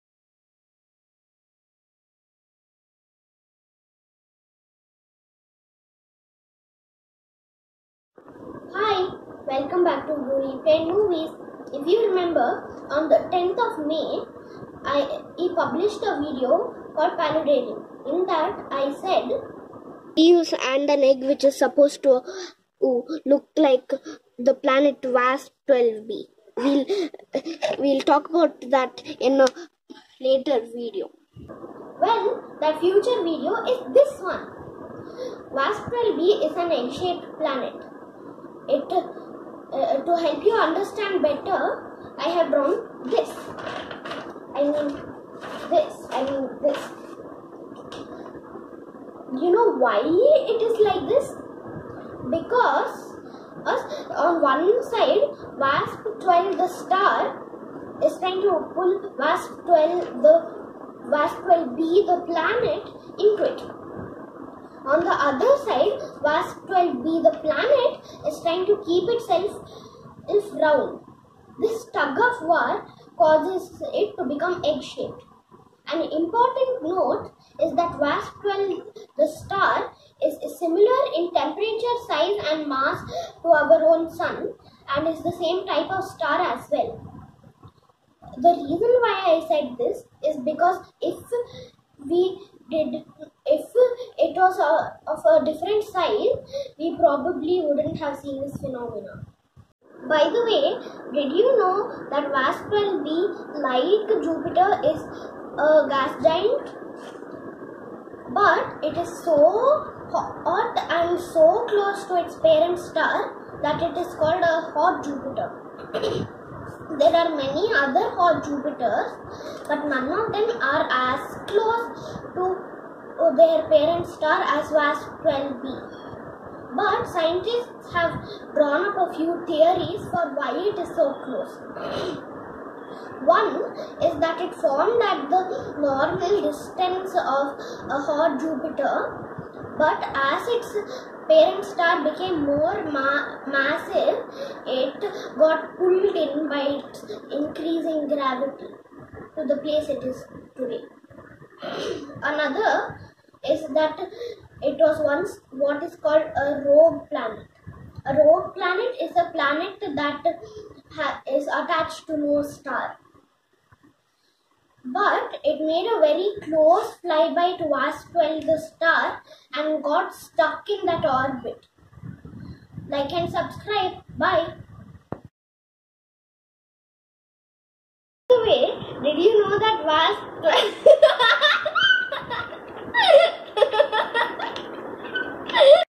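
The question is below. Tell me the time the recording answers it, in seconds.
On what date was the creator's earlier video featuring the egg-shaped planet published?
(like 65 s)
13 s.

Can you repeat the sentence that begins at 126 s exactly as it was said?
But scientists have drawn up a few theories for why it is so close.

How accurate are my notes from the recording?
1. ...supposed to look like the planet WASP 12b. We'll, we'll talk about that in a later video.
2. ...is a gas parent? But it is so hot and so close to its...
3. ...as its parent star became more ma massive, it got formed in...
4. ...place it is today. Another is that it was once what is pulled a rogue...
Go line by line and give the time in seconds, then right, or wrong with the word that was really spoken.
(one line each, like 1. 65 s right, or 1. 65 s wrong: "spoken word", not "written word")
1. 21 s right
2. 104 s wrong: "giant", not "parent"
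3. 140 s wrong: "pulled", not "formed"
4. 149 s wrong: "called", not "pulled".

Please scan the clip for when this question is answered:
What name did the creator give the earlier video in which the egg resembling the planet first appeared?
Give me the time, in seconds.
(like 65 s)
17 s.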